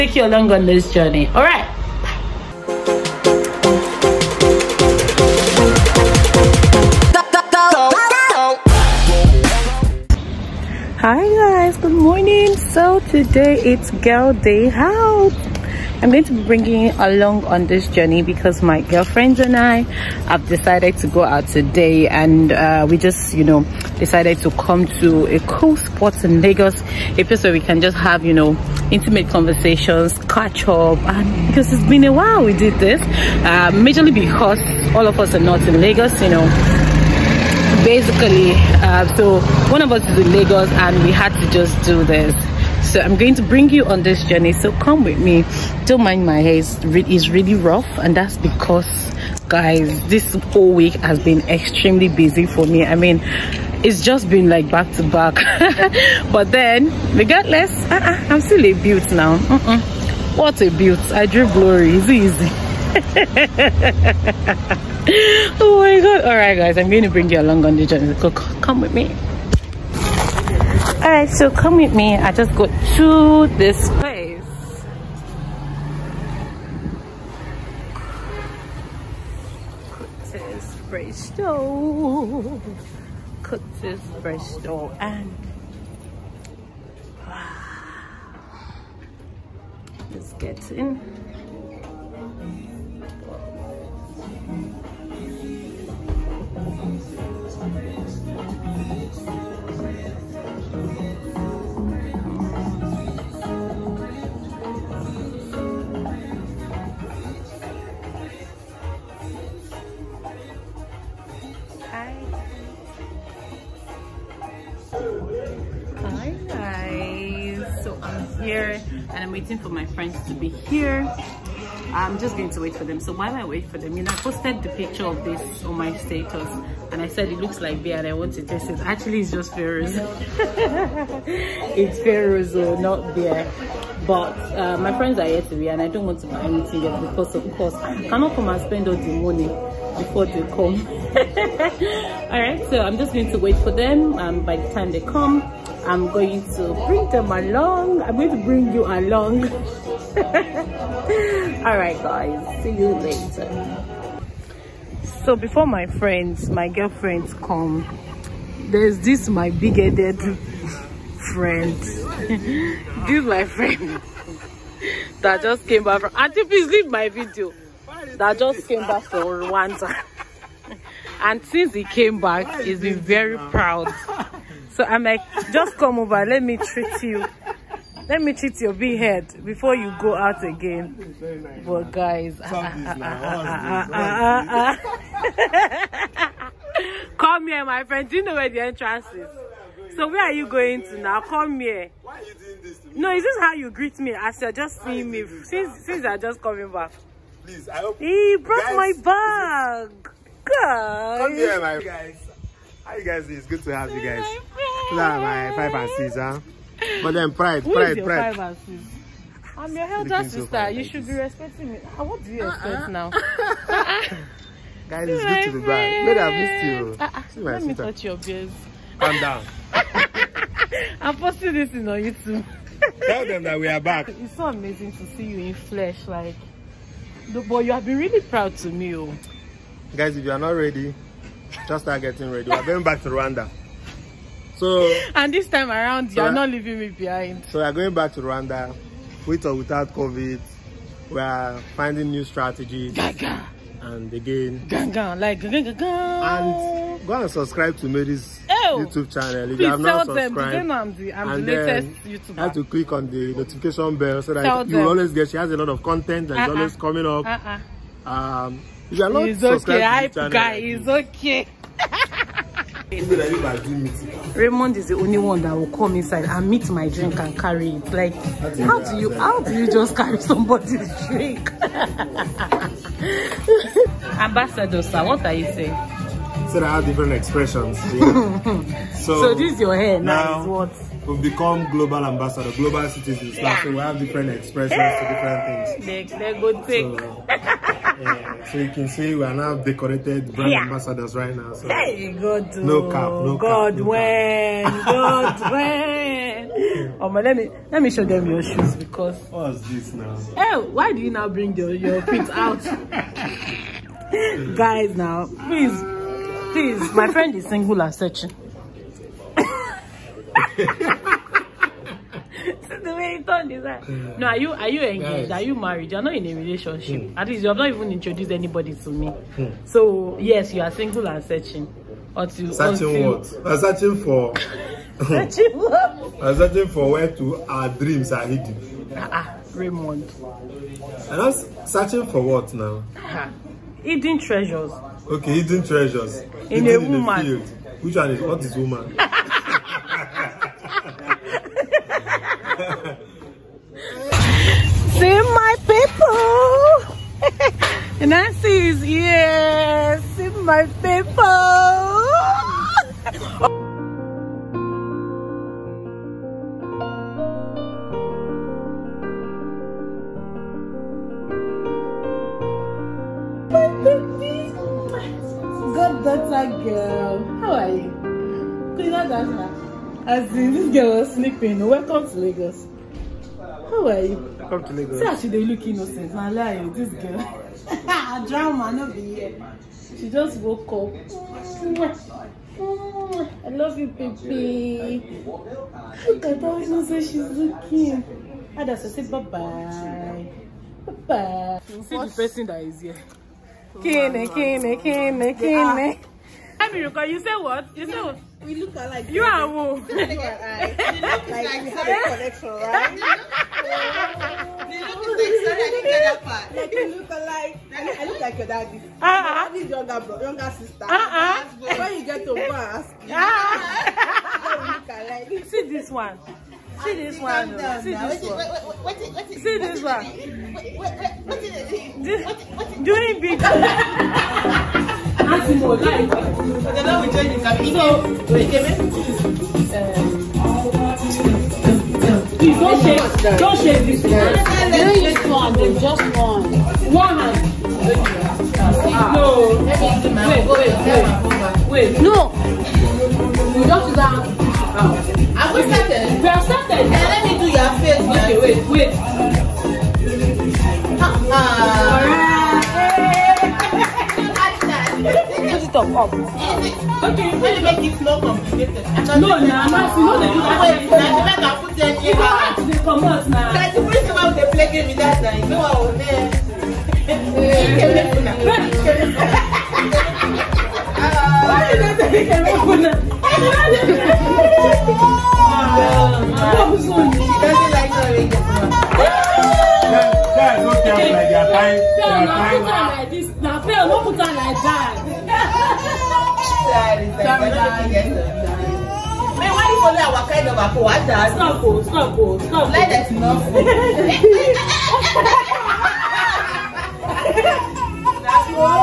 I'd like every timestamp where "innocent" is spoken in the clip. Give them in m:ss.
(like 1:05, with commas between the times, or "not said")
6:15, 6:26.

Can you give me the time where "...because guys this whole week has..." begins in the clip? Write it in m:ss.
0:48.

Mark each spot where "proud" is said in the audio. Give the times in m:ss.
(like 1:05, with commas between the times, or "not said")
2:53, 3:48.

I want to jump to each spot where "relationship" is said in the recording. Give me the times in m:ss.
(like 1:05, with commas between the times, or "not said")
5:16.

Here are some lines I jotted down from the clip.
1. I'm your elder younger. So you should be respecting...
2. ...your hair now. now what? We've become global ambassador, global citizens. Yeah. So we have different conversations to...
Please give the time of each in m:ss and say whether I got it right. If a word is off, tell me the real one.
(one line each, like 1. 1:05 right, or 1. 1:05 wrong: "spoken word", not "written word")
1. 3:29 wrong: "sister", not "younger"
2. 4:39 wrong: "expressions", not "conversations".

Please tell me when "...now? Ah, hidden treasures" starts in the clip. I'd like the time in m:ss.
5:32.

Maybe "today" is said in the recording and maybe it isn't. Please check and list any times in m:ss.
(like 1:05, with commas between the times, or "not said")
0:13, 0:21, 2:15.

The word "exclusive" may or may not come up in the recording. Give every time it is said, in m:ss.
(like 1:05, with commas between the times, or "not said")
not said.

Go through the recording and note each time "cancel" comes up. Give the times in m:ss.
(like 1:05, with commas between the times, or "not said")
not said.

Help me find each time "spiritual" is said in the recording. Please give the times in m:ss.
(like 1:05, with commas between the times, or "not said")
not said.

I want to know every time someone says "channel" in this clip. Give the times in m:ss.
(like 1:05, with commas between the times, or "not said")
4:09, 4:20.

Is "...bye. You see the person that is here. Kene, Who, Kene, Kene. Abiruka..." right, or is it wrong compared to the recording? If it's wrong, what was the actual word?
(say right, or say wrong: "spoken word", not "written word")
wrong: "Kene", not "Who".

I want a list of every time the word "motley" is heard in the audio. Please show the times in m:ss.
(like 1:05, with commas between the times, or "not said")
not said.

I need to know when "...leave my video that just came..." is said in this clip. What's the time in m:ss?
2:46.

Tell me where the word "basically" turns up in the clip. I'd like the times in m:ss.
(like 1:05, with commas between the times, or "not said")
0:37.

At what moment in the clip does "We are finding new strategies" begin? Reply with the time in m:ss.
4:01.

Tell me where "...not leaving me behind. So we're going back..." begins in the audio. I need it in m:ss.
3:56.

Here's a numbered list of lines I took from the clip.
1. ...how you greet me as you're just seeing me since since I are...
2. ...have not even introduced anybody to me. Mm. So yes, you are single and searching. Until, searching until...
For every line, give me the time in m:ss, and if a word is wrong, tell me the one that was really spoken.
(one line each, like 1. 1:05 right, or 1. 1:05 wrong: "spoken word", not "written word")
1. 3:13 right
2. 5:17 right.